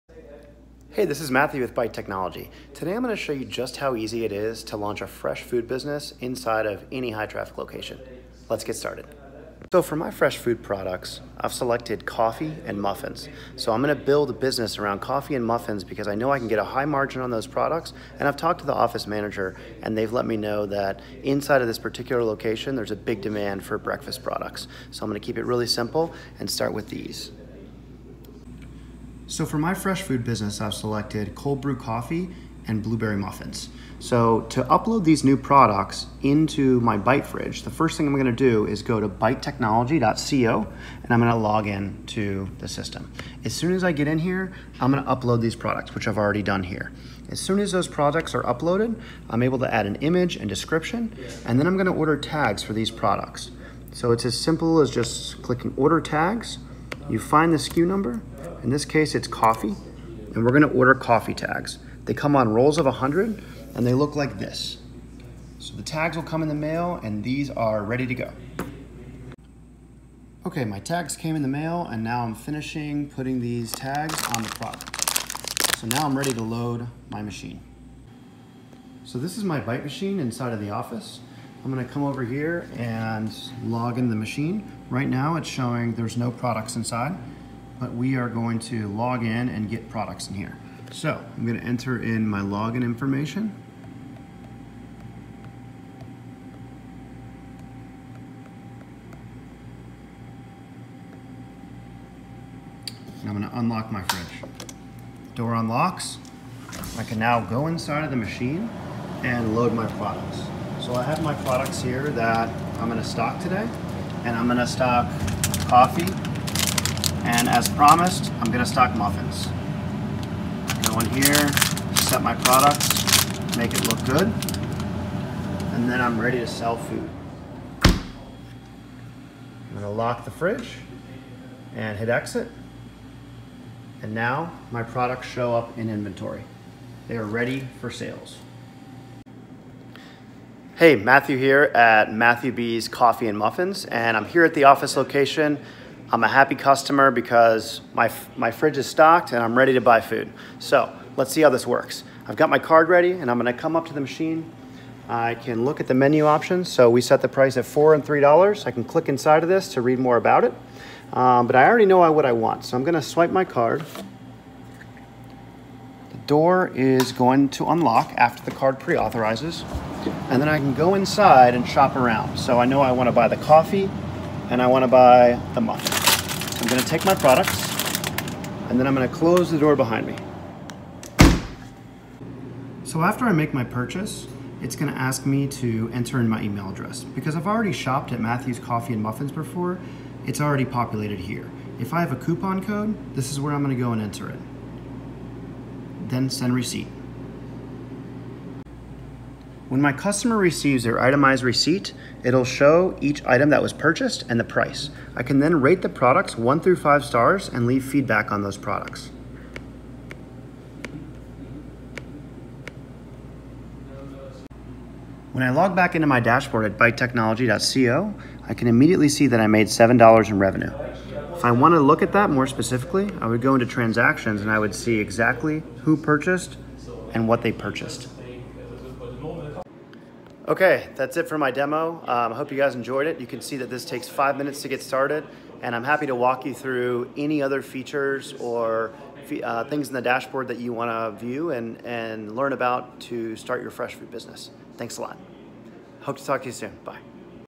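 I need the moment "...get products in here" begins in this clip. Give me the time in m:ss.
1:29.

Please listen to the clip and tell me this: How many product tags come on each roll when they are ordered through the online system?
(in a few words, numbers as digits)
100.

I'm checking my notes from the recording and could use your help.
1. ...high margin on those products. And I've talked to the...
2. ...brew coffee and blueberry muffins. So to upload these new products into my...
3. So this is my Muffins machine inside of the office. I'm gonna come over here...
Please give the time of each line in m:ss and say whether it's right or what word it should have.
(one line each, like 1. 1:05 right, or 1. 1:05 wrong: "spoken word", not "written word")
1. 0:16 right
2. 0:31 right
3. 1:19 wrong: "Byte", not "Muffins".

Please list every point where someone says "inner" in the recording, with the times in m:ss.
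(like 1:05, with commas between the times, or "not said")
not said.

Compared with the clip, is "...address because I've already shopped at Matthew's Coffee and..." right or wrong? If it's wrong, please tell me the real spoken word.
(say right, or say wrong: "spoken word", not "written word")
right.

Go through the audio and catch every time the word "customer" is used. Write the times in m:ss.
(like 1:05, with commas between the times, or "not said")
2:26, 3:19.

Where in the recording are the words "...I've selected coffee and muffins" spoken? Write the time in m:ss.
0:11.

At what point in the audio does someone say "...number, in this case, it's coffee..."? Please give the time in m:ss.
0:57.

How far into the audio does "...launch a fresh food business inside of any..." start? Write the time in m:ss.
0:04.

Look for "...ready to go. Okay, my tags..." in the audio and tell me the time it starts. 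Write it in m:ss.
1:07.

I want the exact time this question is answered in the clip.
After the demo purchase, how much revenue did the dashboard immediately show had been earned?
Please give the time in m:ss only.
3:39.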